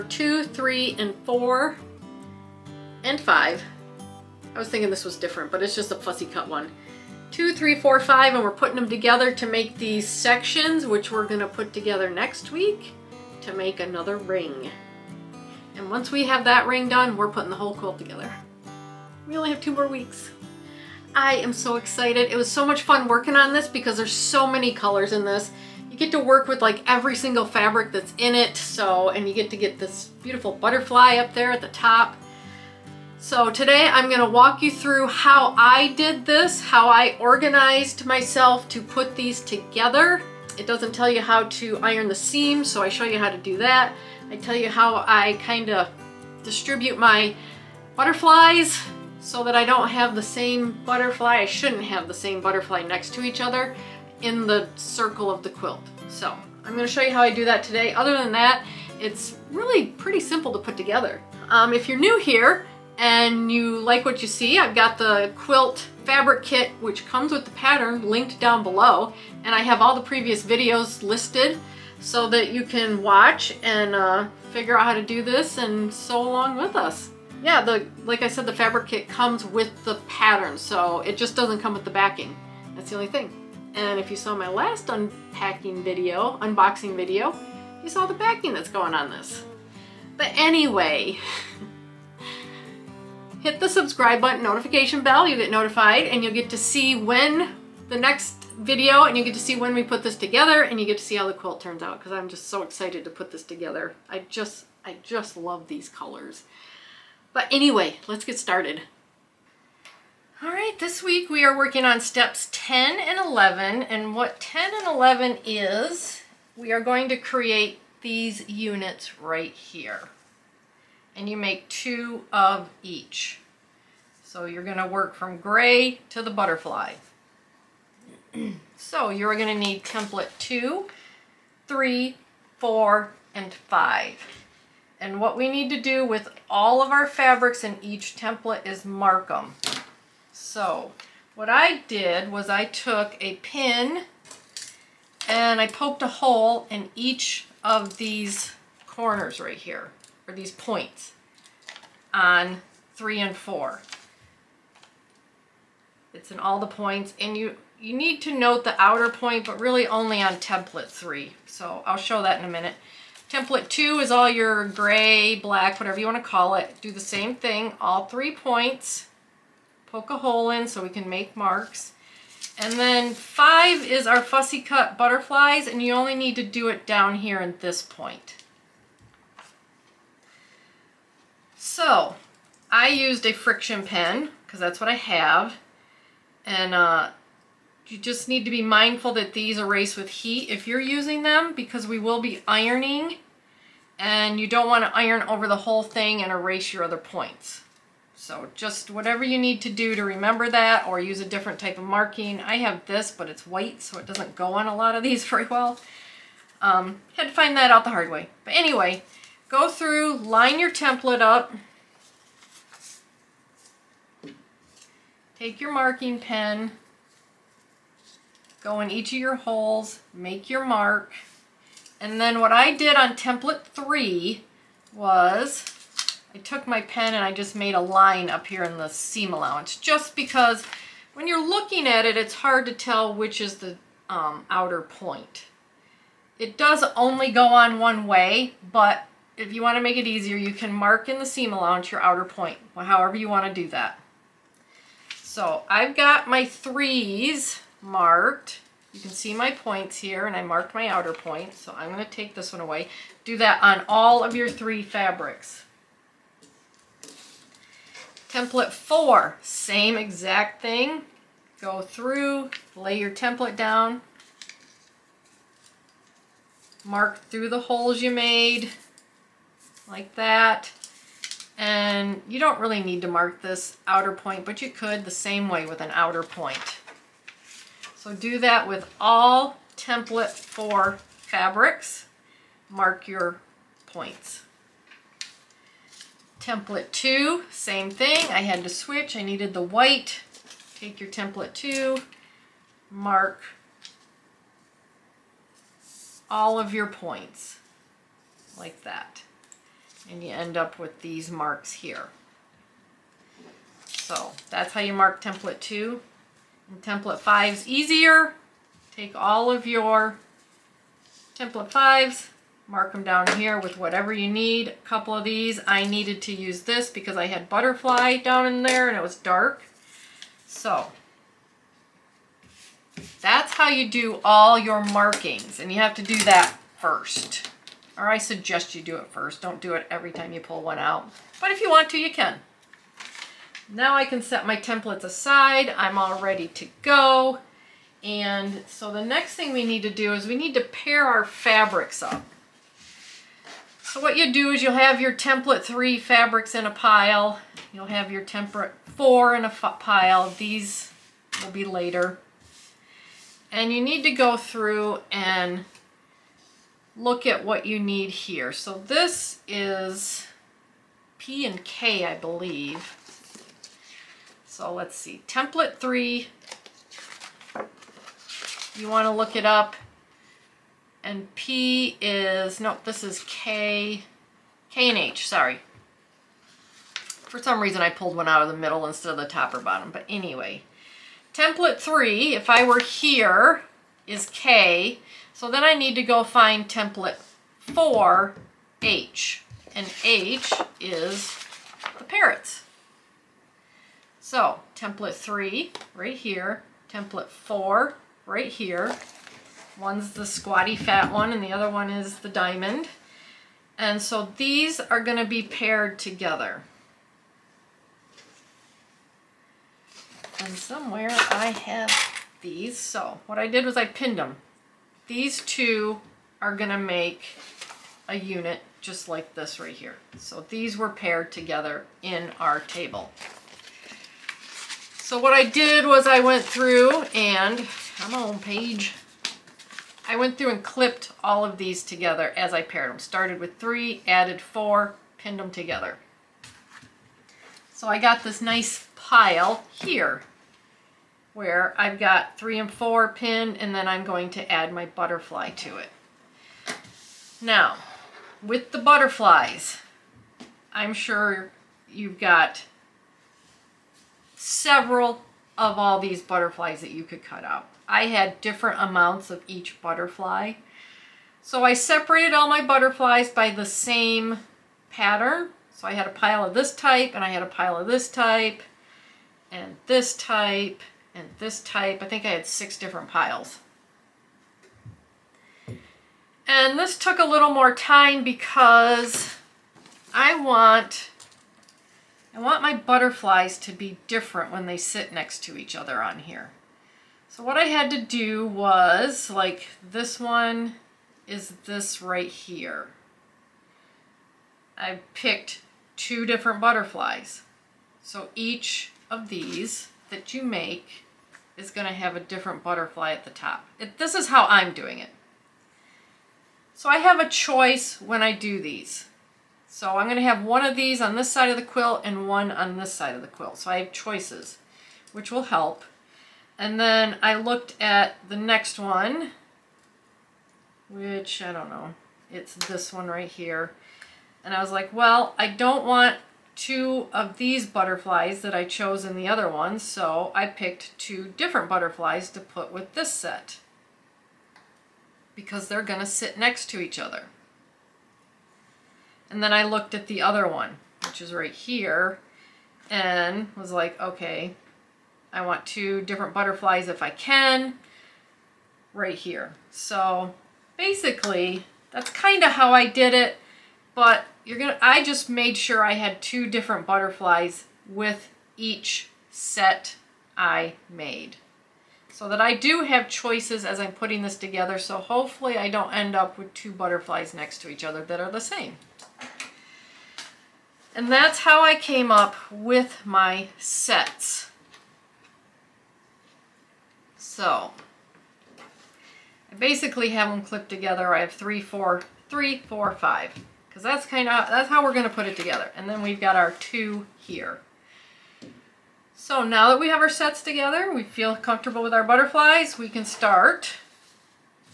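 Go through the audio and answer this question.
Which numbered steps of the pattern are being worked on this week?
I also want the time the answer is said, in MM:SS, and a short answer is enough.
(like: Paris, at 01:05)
10 and 11, at 01:52.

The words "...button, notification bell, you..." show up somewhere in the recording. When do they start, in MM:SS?
01:34.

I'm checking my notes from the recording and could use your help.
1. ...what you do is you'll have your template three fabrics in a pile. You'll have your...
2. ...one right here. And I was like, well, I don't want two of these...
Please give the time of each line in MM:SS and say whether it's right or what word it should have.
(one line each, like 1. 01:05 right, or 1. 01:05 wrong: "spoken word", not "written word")
1. 05:44 right
2. 08:42 right.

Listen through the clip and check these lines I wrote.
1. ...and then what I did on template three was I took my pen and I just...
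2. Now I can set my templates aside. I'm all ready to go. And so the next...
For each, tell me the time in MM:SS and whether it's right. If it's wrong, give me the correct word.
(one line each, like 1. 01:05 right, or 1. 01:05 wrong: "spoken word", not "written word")
1. 03:41 right
2. 05:33 right.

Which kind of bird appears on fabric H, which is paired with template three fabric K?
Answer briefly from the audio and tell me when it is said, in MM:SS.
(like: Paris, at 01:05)
Parrots, at 06:31.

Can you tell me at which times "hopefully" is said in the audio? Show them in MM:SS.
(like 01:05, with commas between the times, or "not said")
09:24.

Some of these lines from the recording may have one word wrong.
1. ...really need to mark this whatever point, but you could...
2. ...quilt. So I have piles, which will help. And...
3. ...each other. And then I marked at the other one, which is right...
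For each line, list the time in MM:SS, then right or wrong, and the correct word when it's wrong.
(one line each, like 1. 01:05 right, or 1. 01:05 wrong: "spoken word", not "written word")
1. 04:32 wrong: "outer", not "whatever"
2. 08:33 wrong: "choices", not "piles"
3. 08:56 wrong: "looked", not "marked".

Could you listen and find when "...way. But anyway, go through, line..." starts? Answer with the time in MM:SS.
03:28.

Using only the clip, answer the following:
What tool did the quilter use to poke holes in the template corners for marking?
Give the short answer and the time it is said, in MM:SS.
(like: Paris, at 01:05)
A pin, at 02:23.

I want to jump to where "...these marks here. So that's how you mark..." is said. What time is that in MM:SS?
05:01.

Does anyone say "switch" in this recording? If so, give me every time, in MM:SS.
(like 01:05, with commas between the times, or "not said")
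04:48.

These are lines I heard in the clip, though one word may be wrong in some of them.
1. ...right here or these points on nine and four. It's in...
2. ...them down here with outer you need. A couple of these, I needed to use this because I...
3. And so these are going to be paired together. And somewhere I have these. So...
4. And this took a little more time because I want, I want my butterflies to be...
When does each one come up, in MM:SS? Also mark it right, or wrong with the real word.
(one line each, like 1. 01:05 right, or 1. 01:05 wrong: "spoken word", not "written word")
1. 02:29 wrong: "three", not "nine"
2. 05:12 wrong: "whatever", not "outer"
3. 06:43 right
4. 07:56 right.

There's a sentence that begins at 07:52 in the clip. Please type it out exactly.
I think I had six different piles.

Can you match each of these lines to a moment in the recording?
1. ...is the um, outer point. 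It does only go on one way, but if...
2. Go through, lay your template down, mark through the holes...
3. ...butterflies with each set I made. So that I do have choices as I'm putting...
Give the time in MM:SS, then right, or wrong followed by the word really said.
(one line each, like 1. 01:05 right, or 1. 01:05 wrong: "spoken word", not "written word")
1. 03:53 right
2. 04:21 right
3. 09:16 right.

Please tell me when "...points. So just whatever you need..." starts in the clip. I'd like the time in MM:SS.
03:16.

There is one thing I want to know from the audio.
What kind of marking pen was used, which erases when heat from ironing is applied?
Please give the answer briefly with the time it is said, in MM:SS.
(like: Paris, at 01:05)
Friction pen, at 03:03.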